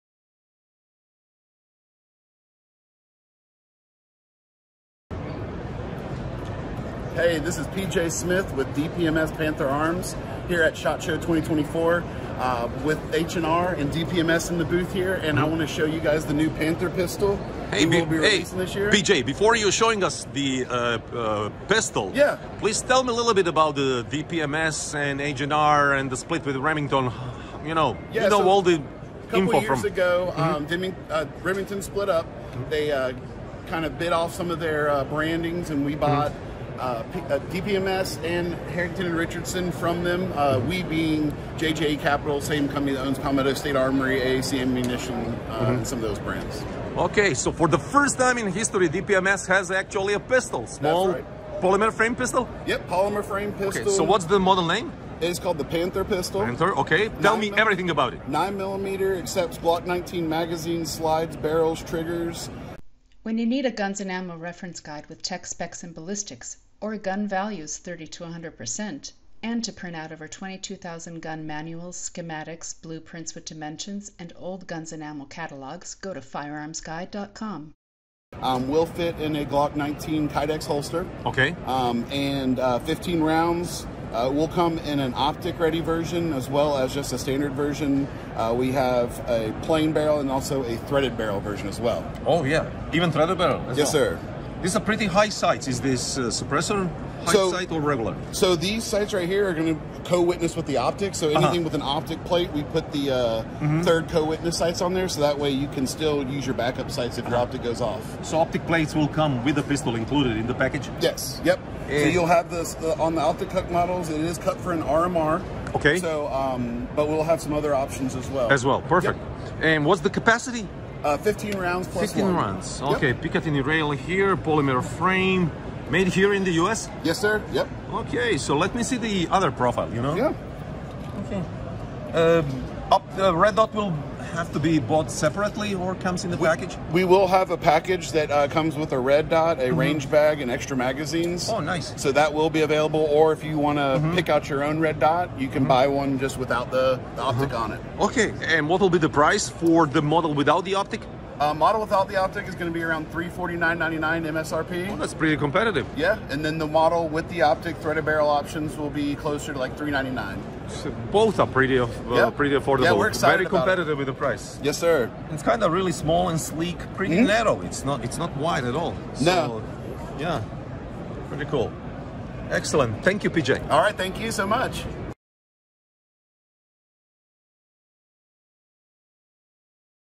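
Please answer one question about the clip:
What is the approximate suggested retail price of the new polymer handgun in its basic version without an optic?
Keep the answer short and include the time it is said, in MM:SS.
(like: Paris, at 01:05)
$349.99, at 02:33.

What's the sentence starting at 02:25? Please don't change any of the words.
buy one just without the, the optic mm-hmm.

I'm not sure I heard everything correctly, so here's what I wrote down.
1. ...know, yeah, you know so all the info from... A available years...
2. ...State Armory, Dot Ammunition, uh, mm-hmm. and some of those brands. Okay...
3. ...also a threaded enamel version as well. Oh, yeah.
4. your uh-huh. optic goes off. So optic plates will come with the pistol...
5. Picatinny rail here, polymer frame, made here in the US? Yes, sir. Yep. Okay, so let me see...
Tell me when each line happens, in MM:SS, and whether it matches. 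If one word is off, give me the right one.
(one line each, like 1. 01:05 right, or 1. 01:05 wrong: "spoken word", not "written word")
1. 00:27 wrong: "couple", not "available"
2. 00:43 wrong: "AAC", not "Dot"
3. 01:30 wrong: "barrel", not "enamel"
4. 01:47 right
5. 02:03 right.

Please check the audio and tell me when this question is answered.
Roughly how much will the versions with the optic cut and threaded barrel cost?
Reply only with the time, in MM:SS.
02:39.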